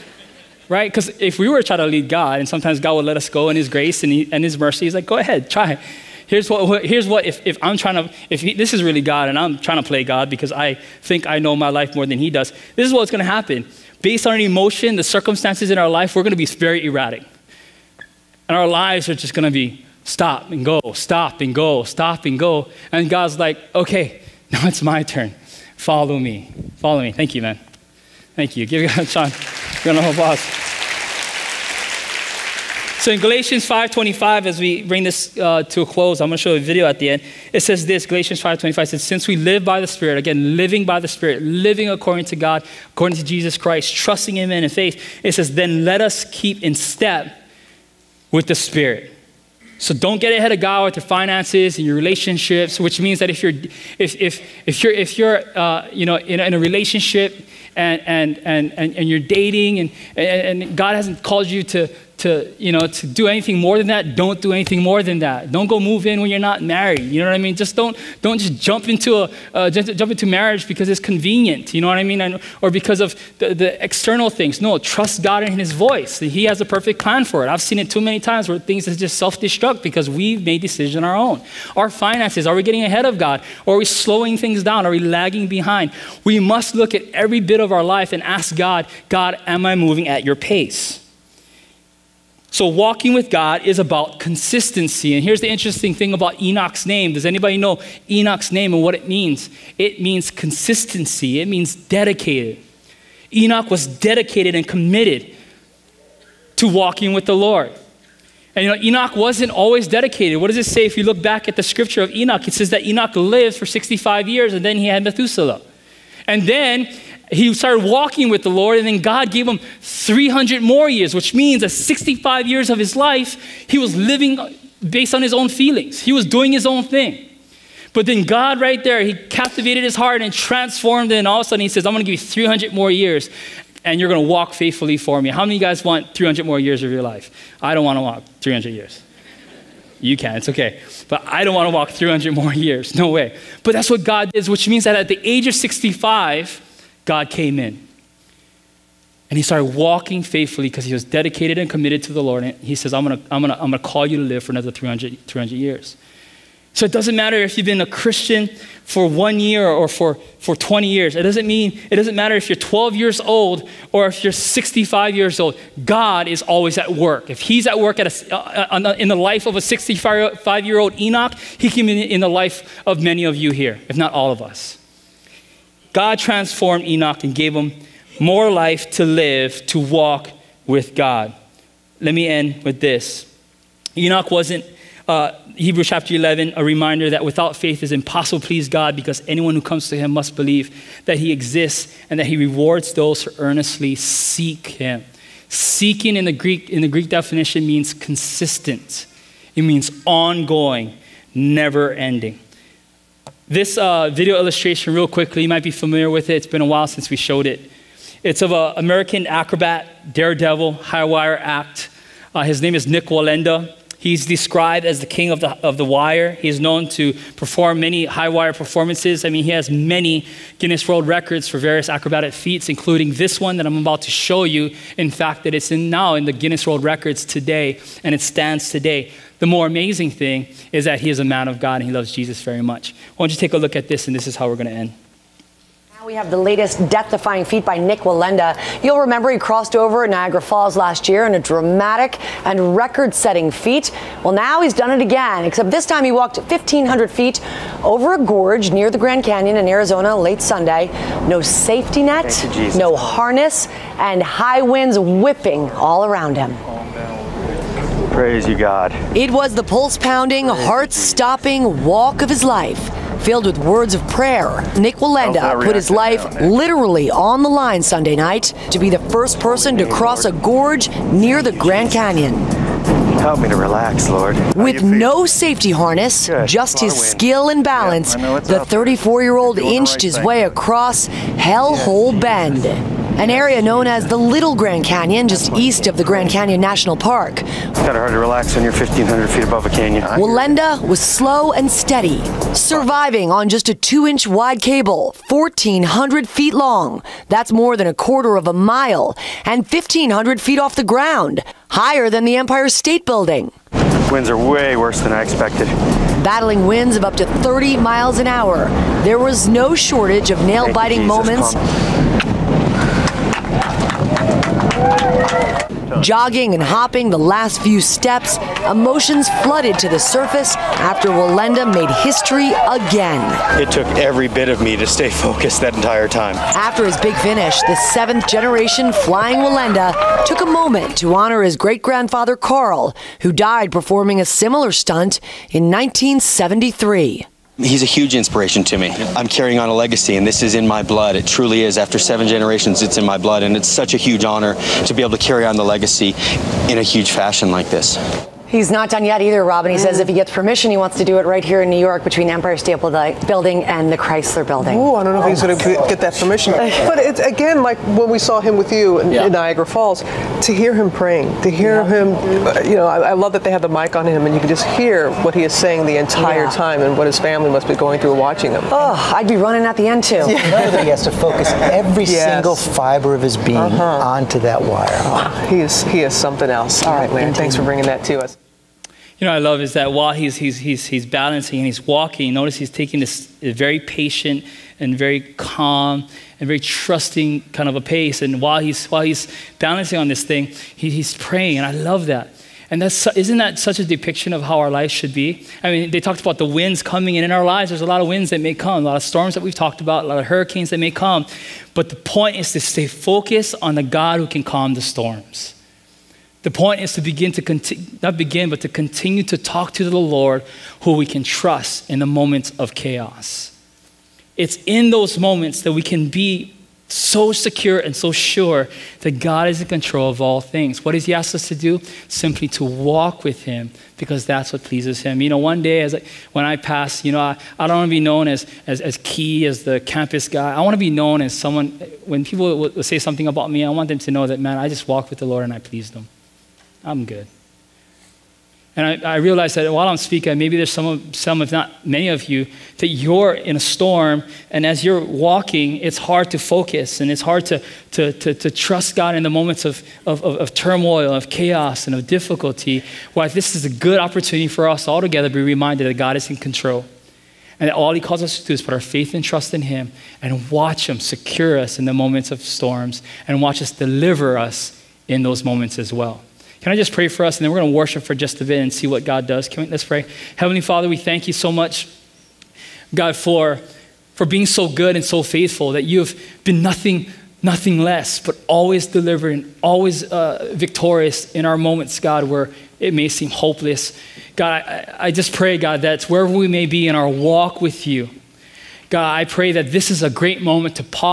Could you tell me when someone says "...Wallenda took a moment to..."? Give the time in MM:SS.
05:29.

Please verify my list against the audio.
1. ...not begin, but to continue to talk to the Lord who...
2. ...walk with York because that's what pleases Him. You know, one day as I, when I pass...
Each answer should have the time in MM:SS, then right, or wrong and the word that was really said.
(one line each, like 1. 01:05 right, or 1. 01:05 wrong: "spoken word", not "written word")
1. 06:48 right
2. 07:02 wrong: "Him", not "York".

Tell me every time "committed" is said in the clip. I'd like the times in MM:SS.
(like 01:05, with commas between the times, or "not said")
01:44, 02:31.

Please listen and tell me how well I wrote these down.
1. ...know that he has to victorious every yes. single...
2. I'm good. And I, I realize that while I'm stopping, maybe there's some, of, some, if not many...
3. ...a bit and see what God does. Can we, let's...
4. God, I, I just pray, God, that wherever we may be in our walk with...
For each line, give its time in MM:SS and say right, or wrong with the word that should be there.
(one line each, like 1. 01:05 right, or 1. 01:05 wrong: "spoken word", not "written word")
1. 06:10 wrong: "focus", not "victorious"
2. 07:16 wrong: "speaking", not "stopping"
3. 07:48 right
4. 08:04 right.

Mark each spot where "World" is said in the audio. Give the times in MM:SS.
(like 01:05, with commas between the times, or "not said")
03:40, 03:46.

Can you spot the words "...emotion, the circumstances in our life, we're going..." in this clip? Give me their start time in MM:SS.
00:14.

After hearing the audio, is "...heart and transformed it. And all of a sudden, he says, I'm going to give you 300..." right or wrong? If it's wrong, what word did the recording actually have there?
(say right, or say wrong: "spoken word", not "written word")
right.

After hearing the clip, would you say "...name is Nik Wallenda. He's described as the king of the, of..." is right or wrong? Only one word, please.
right.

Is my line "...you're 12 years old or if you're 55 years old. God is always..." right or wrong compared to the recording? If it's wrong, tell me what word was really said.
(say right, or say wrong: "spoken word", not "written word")
wrong: "65", not "55".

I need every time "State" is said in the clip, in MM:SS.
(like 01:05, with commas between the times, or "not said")
05:02, 05:52.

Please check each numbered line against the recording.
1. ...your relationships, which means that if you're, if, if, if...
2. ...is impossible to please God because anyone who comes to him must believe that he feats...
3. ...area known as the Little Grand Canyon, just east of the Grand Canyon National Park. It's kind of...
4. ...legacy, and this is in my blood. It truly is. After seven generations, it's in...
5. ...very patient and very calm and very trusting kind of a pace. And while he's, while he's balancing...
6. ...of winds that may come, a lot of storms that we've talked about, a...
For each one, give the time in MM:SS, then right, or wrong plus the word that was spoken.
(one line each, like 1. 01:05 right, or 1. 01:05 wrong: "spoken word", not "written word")
1. 00:51 right
2. 03:07 wrong: "exists", not "feats"
3. 04:43 right
4. 05:39 right
5. 06:23 right
6. 06:38 right.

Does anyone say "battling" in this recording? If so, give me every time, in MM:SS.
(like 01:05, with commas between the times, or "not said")
05:06.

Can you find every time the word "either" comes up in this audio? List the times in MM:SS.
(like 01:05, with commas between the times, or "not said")
05:49.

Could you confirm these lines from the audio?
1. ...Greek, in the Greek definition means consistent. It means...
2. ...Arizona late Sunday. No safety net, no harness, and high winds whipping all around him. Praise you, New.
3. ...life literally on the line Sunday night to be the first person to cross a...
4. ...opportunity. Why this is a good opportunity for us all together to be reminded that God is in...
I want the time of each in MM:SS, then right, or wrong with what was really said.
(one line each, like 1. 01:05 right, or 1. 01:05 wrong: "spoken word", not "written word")
1. 03:16 right
2. 04:09 wrong: "God", not "New"
3. 04:25 right
4. 07:32 wrong: "difficulty", not "opportunity".